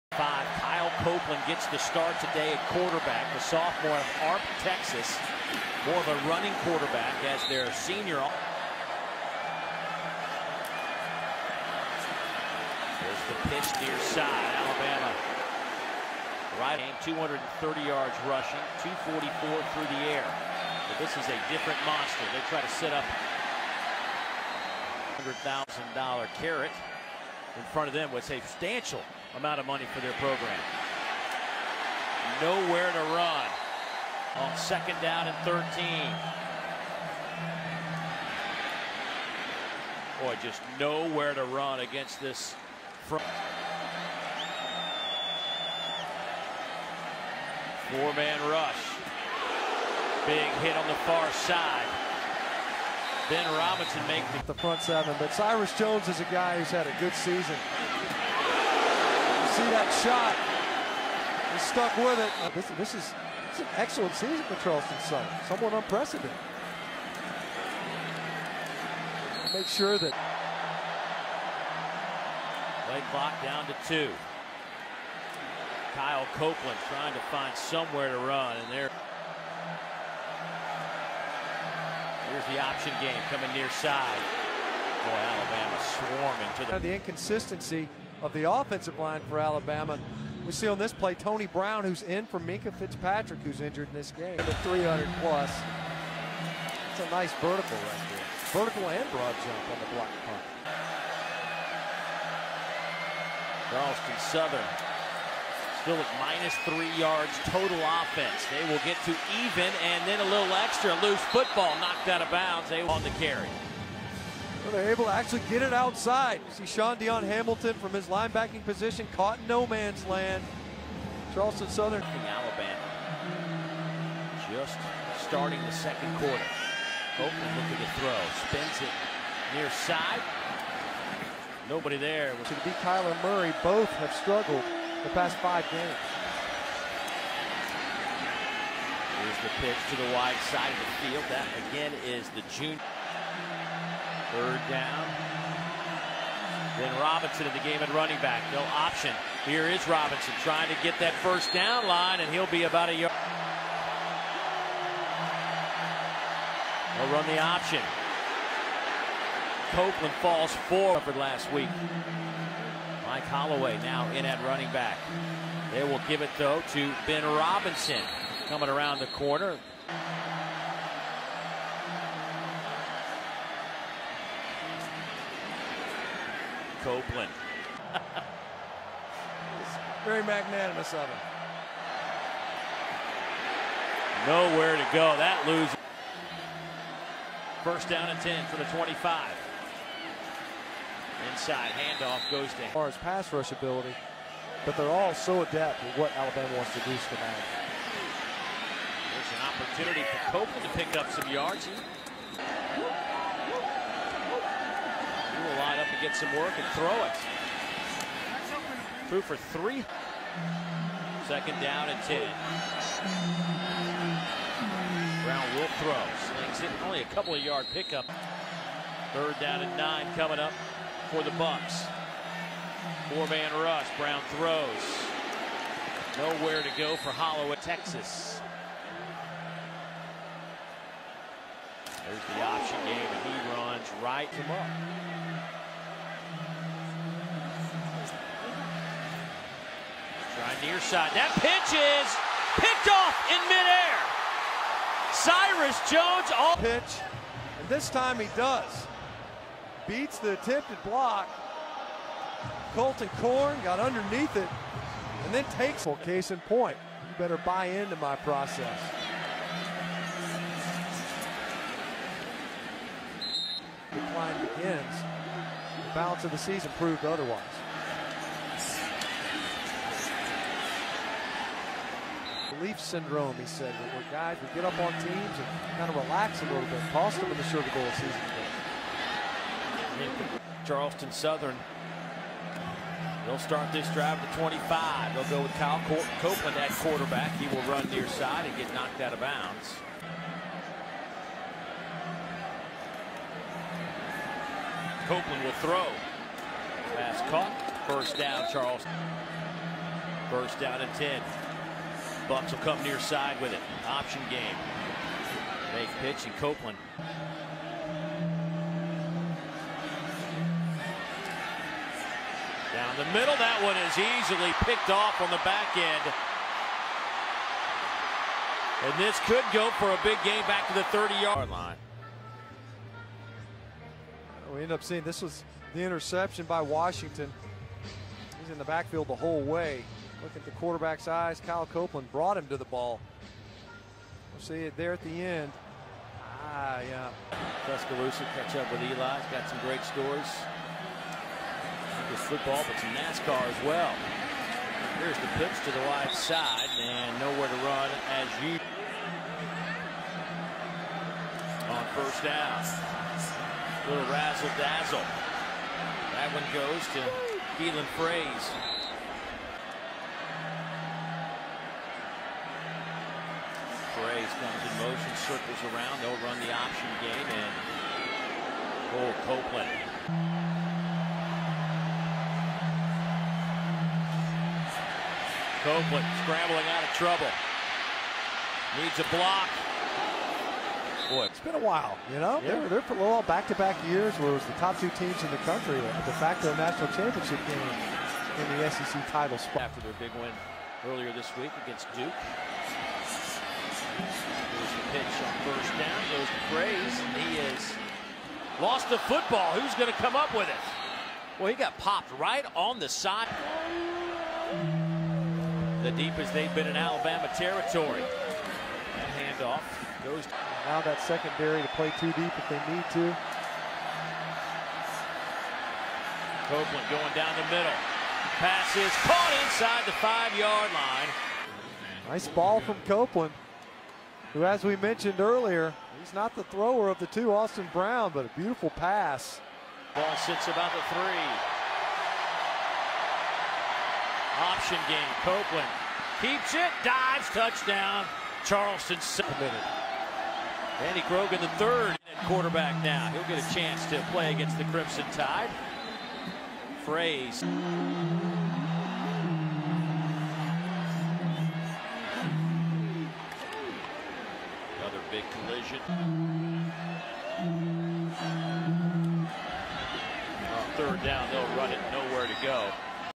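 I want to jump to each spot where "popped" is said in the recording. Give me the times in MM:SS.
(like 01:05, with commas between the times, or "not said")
06:41.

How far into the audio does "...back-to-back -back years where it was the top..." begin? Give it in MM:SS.
06:23.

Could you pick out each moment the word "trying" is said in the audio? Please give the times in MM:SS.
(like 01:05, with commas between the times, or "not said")
01:16, 02:30.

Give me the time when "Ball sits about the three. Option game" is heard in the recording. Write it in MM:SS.
07:09.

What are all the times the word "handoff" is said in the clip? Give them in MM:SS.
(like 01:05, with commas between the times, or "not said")
03:11, 06:49.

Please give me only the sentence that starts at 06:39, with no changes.
Who's going to come up with it?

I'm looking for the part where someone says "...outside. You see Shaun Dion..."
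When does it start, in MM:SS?
01:55.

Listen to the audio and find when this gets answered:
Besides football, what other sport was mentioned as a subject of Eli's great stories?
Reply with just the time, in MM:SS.
05:42.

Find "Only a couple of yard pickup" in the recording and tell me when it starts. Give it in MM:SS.
03:36.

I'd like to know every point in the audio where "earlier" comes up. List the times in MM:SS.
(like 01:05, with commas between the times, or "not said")
06:30, 07:05.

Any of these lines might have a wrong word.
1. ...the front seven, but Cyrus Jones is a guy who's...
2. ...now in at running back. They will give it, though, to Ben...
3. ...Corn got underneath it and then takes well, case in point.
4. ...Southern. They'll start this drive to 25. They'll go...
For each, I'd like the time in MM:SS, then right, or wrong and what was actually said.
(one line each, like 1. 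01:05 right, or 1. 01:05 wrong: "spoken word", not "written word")
1. 00:54 right
2. 02:43 right
3. 04:13 right
4. 04:41 right.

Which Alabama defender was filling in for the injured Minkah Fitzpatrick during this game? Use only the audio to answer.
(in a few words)
Tony Brown.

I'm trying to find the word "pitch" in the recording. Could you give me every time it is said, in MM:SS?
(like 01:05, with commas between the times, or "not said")
00:13, 02:19, 04:01, 04:06, 05:06, 05:45, 06:34.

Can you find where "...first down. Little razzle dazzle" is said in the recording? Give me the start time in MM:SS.
05:51.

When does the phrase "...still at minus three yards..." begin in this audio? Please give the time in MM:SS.
01:45.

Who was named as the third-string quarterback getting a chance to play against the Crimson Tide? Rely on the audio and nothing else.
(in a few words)
Andy Grogan.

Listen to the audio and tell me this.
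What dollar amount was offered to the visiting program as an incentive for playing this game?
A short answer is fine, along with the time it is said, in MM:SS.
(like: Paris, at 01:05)
$100,000, at 00:25.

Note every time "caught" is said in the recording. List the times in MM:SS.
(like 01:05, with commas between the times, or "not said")
01:59, 04:57, 06:59.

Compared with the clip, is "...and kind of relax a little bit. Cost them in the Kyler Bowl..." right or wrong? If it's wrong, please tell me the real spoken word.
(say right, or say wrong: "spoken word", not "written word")
wrong: "Sugar", not "Kyler".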